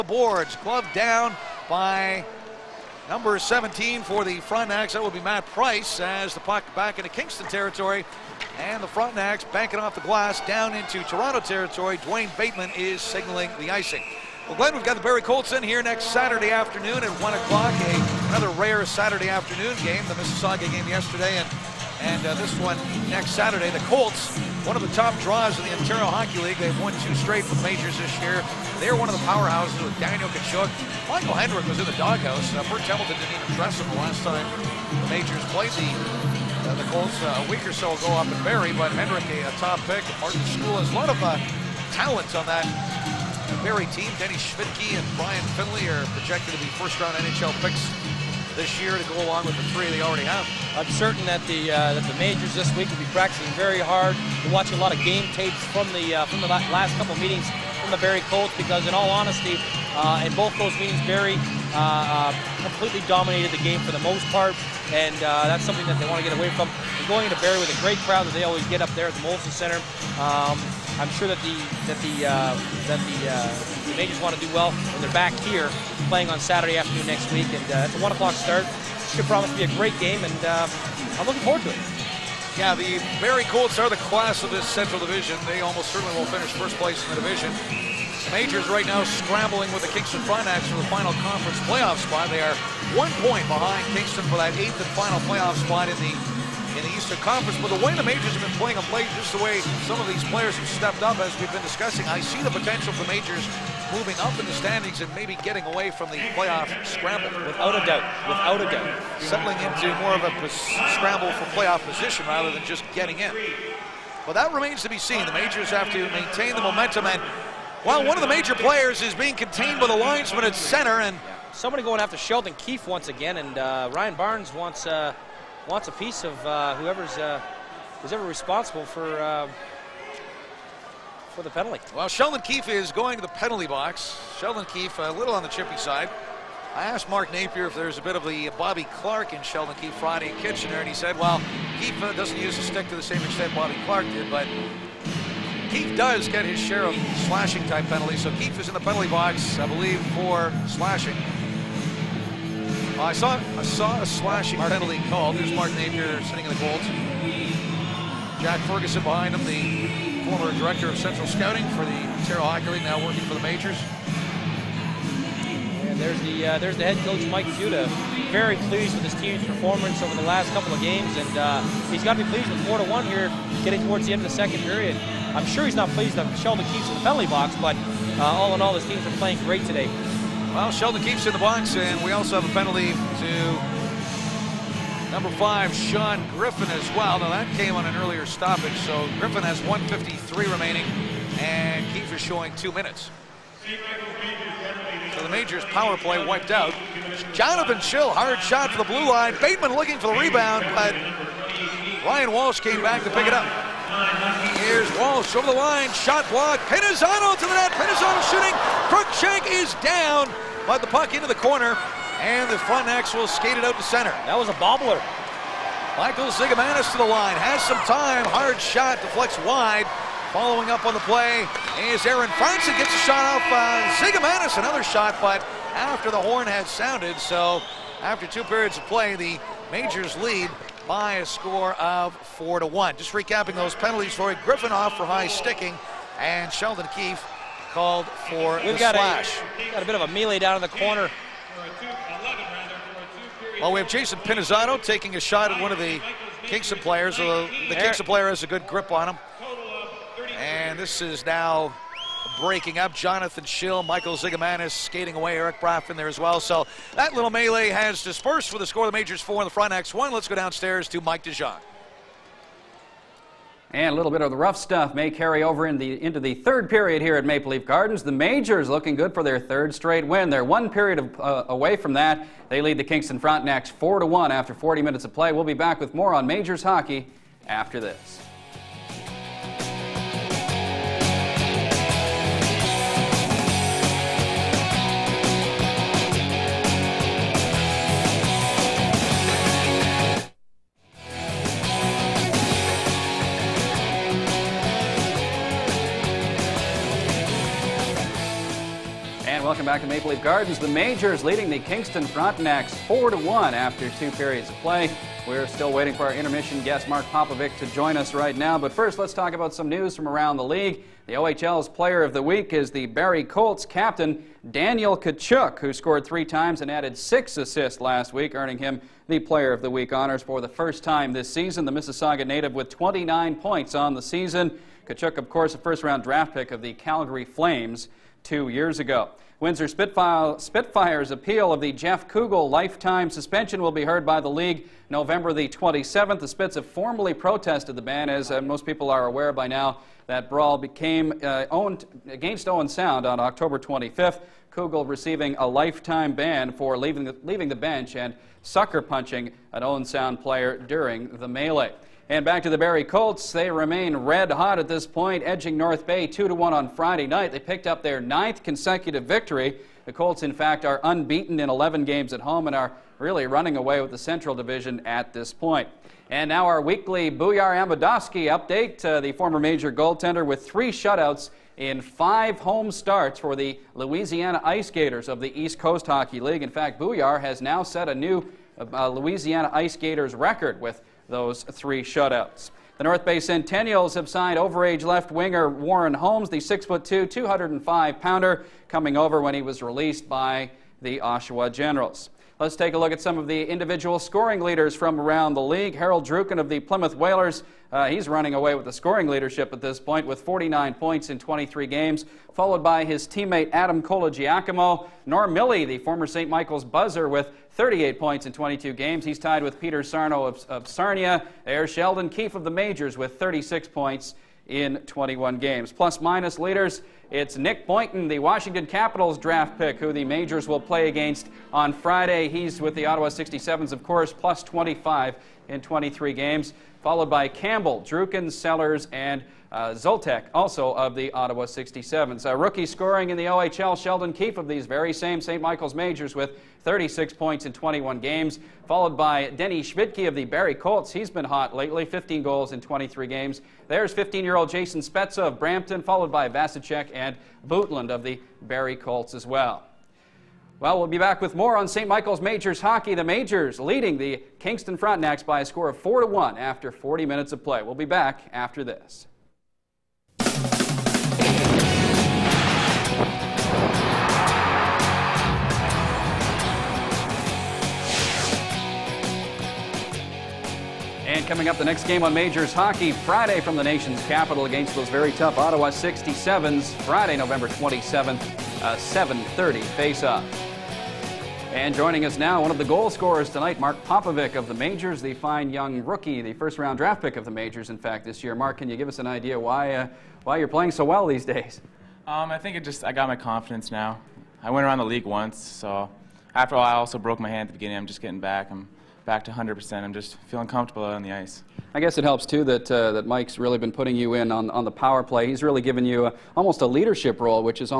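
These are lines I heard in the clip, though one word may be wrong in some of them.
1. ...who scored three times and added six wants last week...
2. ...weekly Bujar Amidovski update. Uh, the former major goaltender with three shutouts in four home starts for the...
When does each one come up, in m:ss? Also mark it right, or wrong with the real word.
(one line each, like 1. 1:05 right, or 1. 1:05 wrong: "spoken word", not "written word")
1. 5:15 wrong: "assists", not "wants"
2. 6:06 wrong: "five", not "four".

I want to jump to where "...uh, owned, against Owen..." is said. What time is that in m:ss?
5:41.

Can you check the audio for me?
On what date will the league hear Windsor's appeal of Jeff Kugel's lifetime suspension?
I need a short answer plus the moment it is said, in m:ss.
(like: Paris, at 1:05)
November 27th, at 5:34.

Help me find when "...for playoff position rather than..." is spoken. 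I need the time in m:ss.
1:51.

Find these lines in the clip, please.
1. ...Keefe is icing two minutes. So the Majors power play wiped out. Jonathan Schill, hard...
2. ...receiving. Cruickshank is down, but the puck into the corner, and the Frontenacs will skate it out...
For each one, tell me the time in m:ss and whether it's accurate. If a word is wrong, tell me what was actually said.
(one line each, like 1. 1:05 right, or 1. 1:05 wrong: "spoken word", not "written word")
1. 3:11 wrong: "showing", not "icing"
2. 3:28 wrong: "shooting", not "receiving".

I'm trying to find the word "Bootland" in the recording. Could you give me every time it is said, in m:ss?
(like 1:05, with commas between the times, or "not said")
7:27.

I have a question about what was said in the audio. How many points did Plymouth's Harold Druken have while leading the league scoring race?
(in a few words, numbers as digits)
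49.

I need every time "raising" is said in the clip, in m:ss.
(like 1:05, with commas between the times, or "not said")
not said.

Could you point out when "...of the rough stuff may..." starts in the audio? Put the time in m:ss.
4:24.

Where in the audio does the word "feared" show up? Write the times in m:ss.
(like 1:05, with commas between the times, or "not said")
not said.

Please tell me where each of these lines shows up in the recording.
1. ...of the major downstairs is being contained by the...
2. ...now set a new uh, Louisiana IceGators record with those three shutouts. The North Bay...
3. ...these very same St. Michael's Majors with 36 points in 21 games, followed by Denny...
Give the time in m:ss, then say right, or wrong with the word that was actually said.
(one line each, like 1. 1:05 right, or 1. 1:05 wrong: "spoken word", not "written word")
1. 1:58 wrong: "players", not "downstairs"
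2. 6:17 right
3. 7:14 right.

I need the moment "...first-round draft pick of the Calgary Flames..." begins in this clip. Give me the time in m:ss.
5:25.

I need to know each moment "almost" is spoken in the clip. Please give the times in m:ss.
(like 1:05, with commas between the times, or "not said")
1:25, 8:26.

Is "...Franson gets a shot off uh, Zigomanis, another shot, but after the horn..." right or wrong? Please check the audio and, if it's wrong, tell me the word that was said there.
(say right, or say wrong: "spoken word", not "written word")
right.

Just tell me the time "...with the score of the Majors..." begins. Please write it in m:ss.
4:18.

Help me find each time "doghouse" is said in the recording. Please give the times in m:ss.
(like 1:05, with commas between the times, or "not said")
0:31.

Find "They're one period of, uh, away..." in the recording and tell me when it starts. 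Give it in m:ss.
4:30.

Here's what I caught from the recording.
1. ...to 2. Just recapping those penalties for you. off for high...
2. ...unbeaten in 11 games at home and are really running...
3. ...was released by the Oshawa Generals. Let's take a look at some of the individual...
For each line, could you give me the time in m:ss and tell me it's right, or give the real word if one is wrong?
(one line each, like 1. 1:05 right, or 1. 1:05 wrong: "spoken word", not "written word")
1. 3:52 wrong: "1", not "2"
2. 6:00 right
3. 6:29 right.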